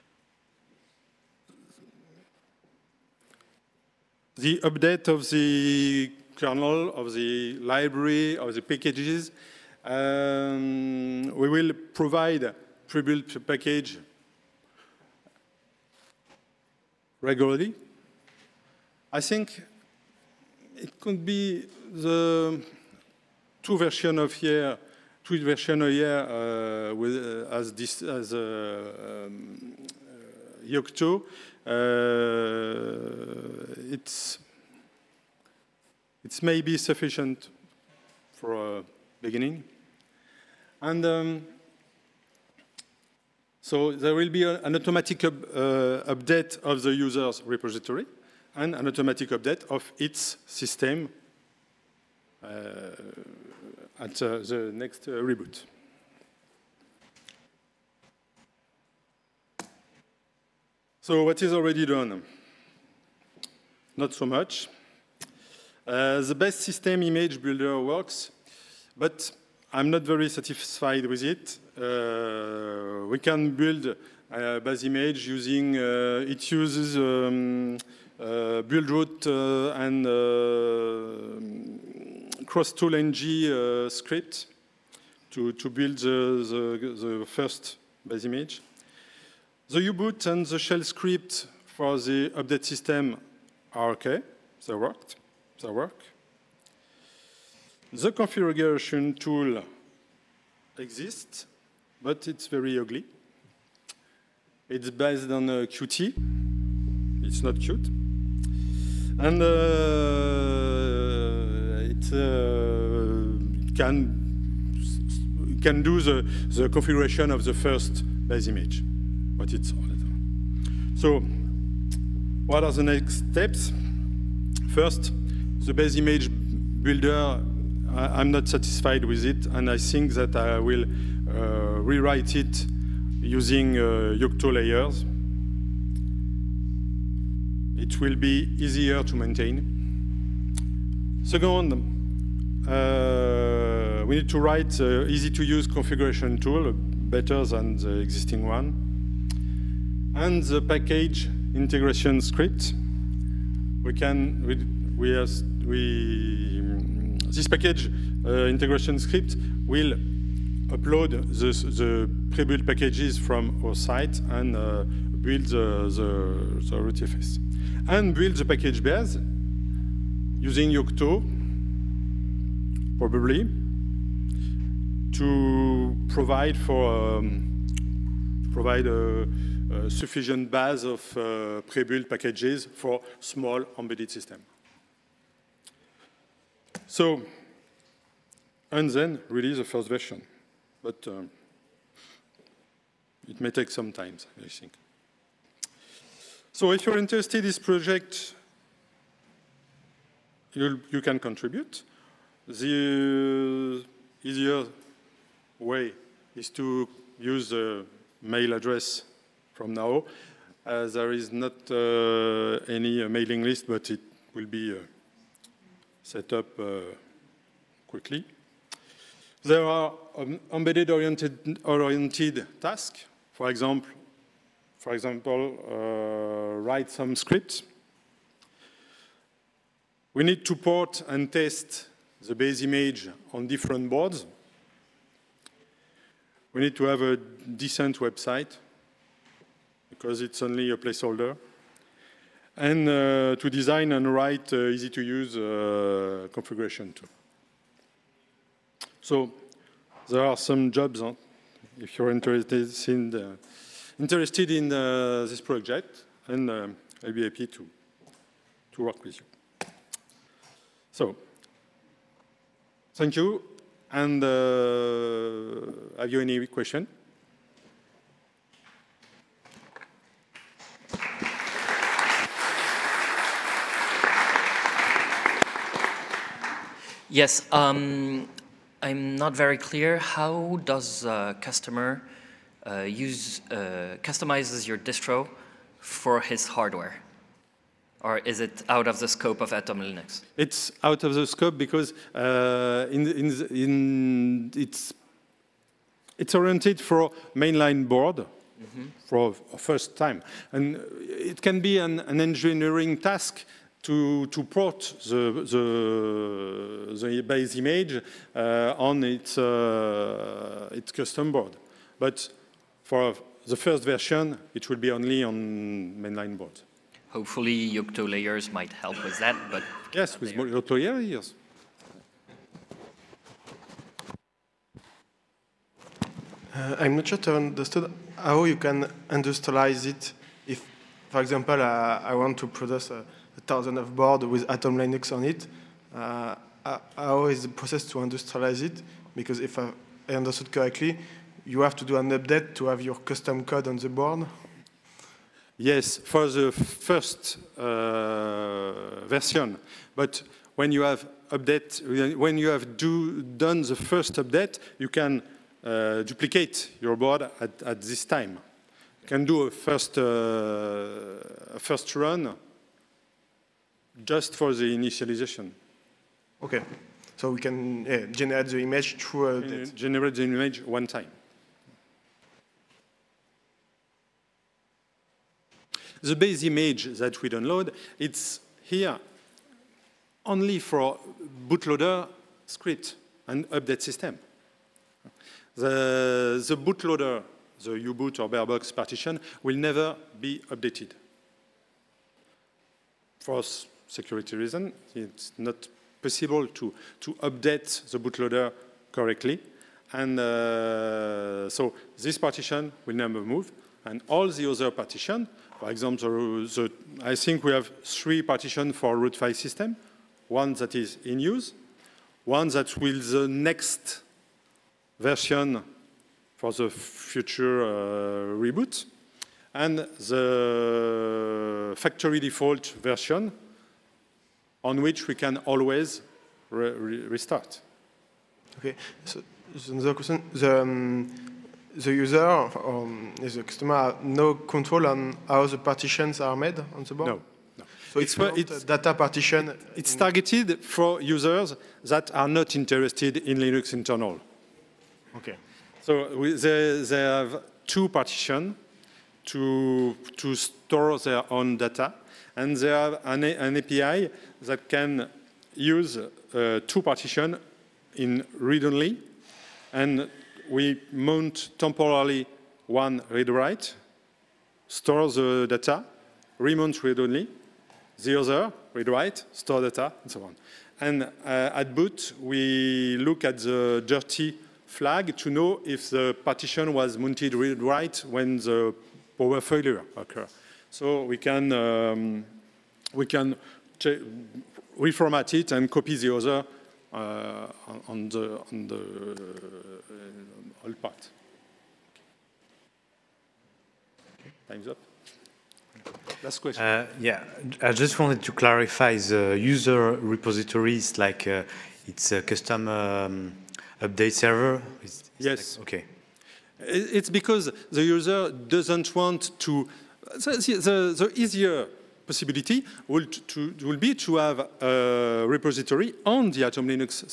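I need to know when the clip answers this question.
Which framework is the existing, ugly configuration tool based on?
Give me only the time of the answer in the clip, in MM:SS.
01:45.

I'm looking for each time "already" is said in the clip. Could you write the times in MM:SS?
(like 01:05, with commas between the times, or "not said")
01:01.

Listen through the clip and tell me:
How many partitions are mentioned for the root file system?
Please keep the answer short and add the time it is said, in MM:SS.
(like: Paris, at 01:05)
3, at 06:47.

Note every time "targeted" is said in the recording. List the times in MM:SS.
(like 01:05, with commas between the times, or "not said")
07:19.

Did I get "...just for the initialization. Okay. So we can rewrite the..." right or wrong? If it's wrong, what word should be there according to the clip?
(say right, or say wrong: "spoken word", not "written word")
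wrong: "generate", not "rewrite".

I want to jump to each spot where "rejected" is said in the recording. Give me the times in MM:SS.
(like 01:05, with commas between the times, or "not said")
not said.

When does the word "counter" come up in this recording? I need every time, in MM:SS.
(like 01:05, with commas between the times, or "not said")
not said.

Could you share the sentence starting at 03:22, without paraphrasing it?
The easier way is to use the mail address from now.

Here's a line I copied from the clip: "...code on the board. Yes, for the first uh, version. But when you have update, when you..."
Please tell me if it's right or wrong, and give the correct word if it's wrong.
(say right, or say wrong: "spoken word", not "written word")
right.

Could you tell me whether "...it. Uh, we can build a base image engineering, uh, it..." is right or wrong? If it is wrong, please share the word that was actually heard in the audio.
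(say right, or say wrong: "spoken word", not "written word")
wrong: "using", not "engineering".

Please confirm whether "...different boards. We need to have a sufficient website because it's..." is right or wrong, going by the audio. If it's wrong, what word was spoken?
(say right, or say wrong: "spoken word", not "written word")
wrong: "decent", not "sufficient".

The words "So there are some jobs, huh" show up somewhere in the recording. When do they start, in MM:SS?
04:09.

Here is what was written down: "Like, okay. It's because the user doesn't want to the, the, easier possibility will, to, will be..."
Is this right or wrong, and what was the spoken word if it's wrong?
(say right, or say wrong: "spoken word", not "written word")
right.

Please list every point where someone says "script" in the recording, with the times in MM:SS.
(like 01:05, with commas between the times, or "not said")
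01:23, 01:30, 02:32, 02:38, 03:47, 06:22.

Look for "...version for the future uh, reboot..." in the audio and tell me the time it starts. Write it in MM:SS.
06:54.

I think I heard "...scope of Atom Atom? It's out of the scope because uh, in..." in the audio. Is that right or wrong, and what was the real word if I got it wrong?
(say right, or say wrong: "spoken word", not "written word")
wrong: "Linux", not "Atom".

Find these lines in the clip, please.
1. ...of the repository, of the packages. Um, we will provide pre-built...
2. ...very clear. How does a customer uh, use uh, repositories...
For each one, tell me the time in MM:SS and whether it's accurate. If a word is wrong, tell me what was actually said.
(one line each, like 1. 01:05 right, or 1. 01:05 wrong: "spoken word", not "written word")
1. 00:06 wrong: "library", not "repository"
2. 04:39 wrong: "customizes", not "repositories".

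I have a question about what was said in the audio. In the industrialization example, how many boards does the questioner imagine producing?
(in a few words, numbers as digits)
1000.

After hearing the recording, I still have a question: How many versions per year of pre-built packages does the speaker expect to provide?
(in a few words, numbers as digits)
2.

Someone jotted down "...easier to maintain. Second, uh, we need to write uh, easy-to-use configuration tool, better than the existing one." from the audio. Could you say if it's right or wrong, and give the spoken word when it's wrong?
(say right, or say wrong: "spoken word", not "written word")
right.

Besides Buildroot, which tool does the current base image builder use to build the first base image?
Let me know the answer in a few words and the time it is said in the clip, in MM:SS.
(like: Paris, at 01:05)
crosstool-NG, at 01:22.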